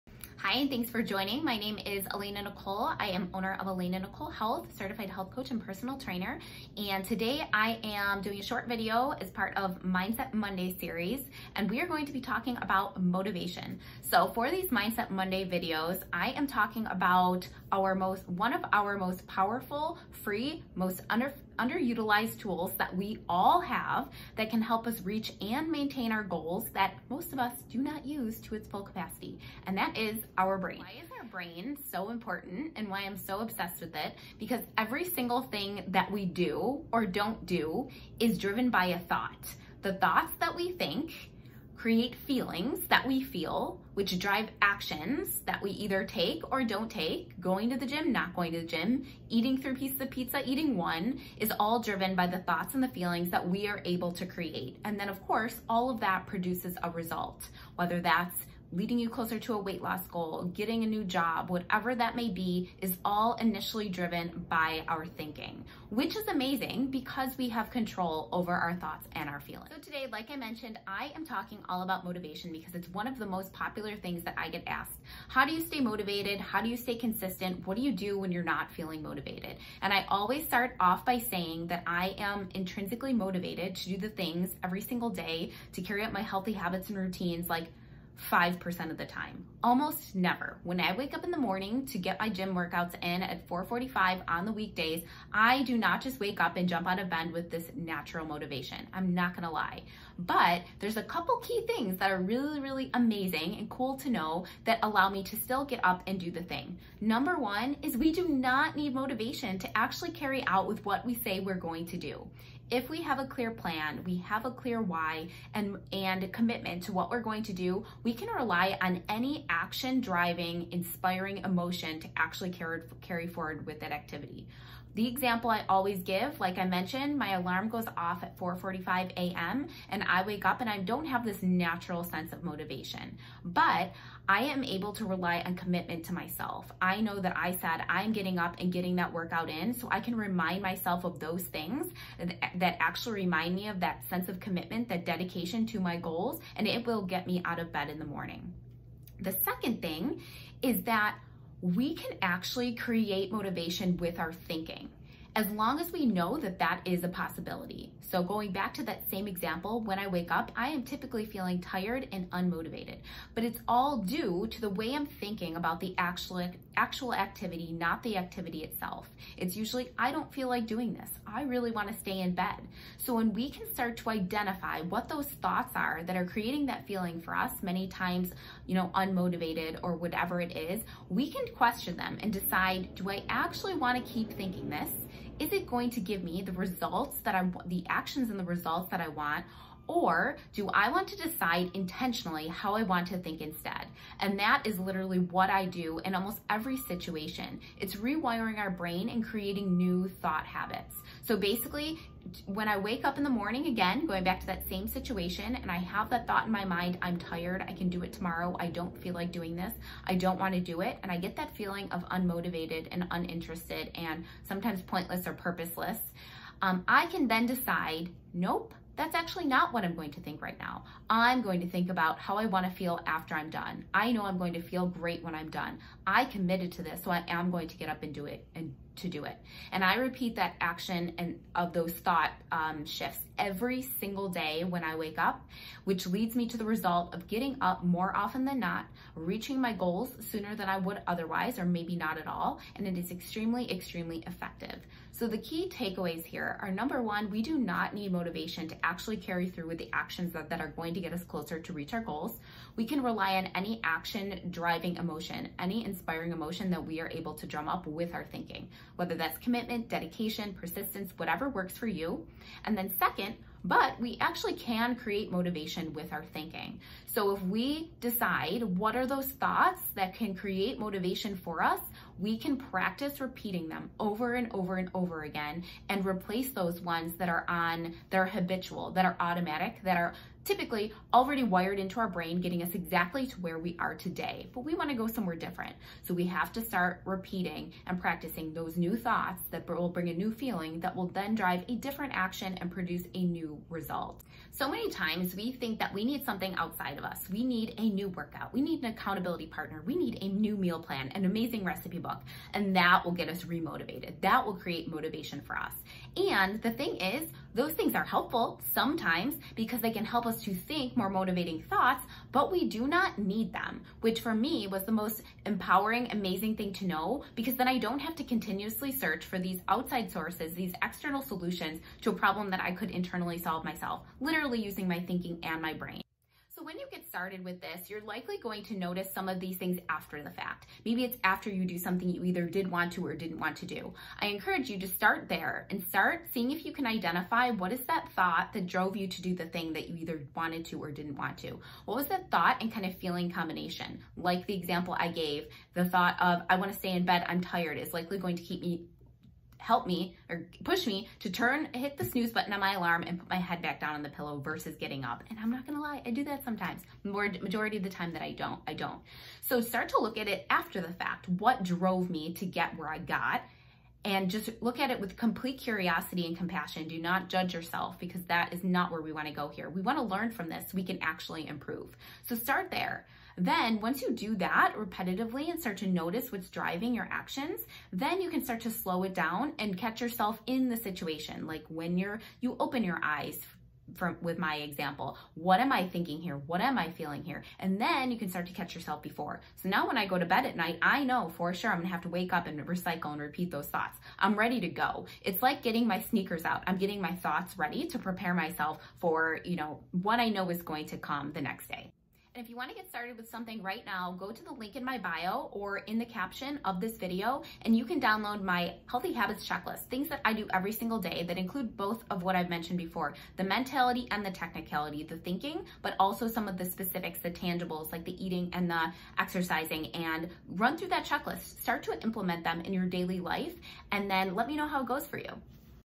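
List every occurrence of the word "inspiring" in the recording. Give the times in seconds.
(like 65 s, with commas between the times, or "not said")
120 s, 255 s.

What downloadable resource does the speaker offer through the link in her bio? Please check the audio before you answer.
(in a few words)
Healthy habits checklist.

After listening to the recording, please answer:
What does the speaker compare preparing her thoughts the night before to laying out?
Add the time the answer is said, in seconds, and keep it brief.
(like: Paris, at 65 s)
Sneakers, at 396 s.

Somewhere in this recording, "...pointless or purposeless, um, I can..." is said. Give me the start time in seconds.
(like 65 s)
214 s.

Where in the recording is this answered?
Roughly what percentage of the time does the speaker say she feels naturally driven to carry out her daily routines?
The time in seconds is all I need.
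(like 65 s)
88 s.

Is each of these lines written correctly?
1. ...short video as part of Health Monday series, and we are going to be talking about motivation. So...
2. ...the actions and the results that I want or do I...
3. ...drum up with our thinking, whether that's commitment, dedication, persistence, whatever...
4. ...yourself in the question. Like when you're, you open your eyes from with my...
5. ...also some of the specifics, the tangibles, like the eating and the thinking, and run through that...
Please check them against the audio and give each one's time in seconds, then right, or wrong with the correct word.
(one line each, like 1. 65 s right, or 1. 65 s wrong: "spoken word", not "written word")
1. 8 s wrong: "Mindset", not "Health"
2. 187 s right
3. 257 s right
4. 380 s wrong: "situation", not "question"
5. 415 s wrong: "exercising", not "thinking".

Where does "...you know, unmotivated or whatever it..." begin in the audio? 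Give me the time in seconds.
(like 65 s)
178 s.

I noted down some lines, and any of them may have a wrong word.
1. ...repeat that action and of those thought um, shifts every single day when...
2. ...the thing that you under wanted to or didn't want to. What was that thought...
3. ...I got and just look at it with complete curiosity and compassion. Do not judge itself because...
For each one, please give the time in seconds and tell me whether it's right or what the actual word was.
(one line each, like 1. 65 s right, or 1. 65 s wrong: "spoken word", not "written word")
1. 229 s right
2. 339 s wrong: "either", not "under"
3. 362 s wrong: "yourself", not "itself".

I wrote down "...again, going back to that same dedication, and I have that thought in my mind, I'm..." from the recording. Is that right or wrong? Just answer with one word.
wrong.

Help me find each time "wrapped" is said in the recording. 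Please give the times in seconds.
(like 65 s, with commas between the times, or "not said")
not said.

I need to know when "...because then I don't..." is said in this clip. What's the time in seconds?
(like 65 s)
317 s.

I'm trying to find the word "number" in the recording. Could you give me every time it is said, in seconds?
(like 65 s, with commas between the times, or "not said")
106 s, 246 s.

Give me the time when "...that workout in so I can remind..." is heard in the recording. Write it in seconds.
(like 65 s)
138 s.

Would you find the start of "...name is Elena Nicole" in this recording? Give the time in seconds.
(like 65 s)
1 s.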